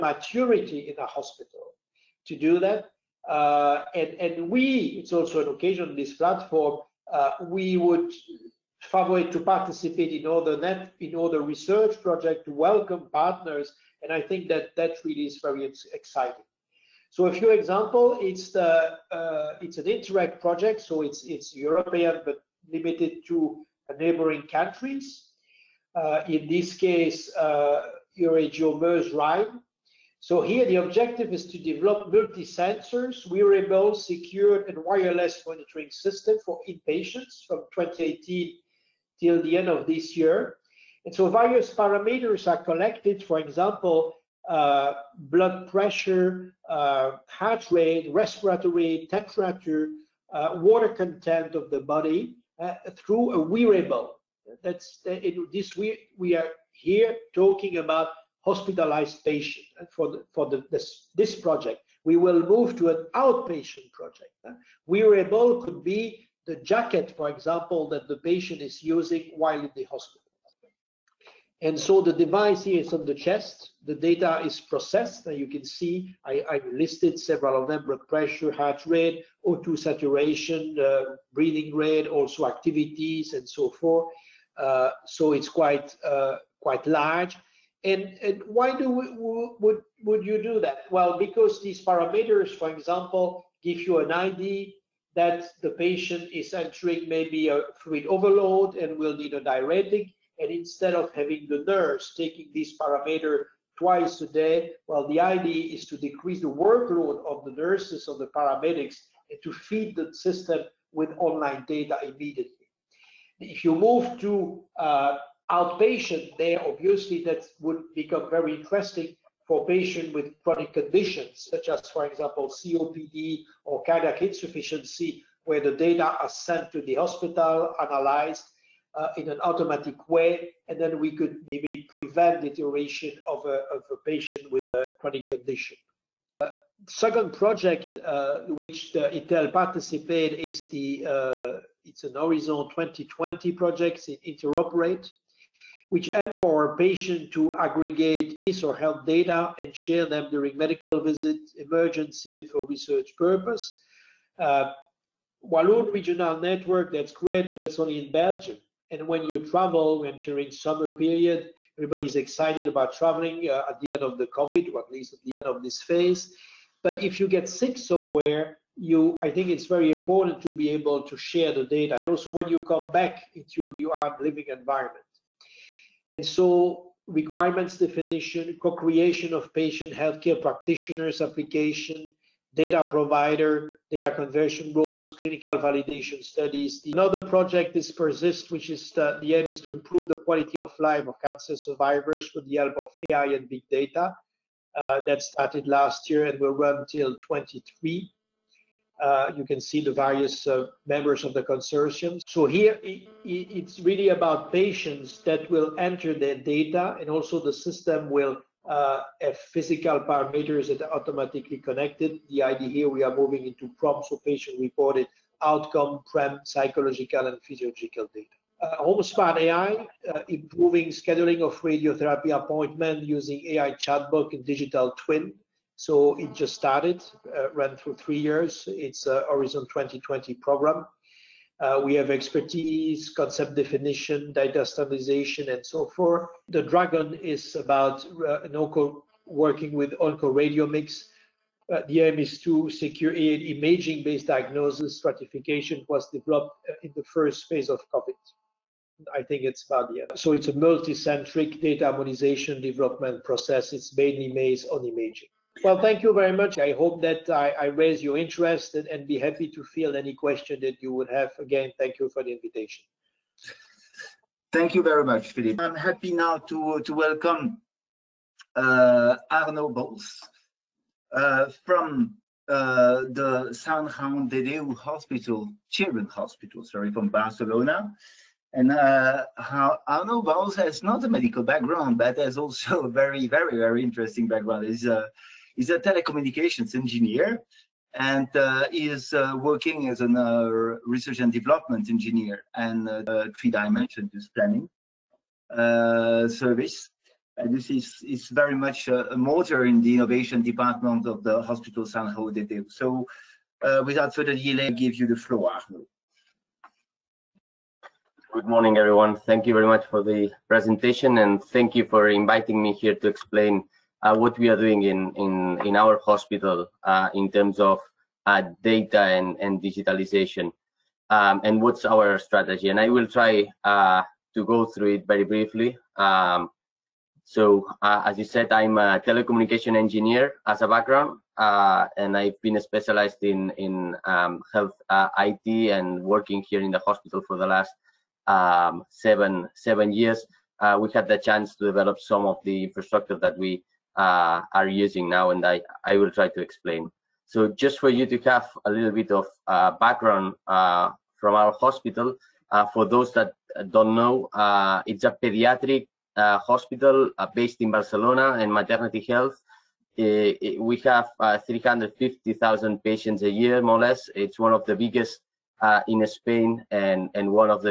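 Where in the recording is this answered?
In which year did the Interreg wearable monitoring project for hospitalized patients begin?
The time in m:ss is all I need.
0:37.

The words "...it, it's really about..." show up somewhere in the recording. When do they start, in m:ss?
3:22.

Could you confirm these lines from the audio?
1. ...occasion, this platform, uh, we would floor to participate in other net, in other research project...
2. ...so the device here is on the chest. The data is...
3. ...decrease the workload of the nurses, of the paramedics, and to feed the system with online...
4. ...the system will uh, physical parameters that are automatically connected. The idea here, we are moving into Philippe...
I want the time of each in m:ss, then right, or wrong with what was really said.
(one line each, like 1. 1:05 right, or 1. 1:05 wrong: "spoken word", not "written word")
1. 0:05 wrong: "favor", not "floor"
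2. 1:11 right
3. 1:45 right
4. 3:27 wrong: "PROMs", not "Philippe".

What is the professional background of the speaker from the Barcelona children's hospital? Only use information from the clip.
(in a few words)
telecommunications engineer.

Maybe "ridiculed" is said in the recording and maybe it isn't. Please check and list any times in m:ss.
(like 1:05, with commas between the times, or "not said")
not said.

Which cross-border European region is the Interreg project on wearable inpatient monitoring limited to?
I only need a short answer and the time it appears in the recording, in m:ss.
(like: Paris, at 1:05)
Euregio Meuse-Rhine, at 0:28.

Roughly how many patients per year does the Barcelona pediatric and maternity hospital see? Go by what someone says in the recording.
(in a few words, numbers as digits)
350,000.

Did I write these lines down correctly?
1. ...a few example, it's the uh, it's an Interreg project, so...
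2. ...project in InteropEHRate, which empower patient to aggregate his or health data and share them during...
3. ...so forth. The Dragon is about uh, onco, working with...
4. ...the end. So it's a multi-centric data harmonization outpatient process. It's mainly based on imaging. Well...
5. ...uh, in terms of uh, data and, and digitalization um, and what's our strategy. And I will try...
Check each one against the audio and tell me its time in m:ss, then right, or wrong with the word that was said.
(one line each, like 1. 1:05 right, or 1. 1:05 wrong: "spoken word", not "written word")
1. 0:17 right
2. 2:23 right
3. 3:55 right
4. 4:09 wrong: "development", not "outpatient"
5. 5:16 right.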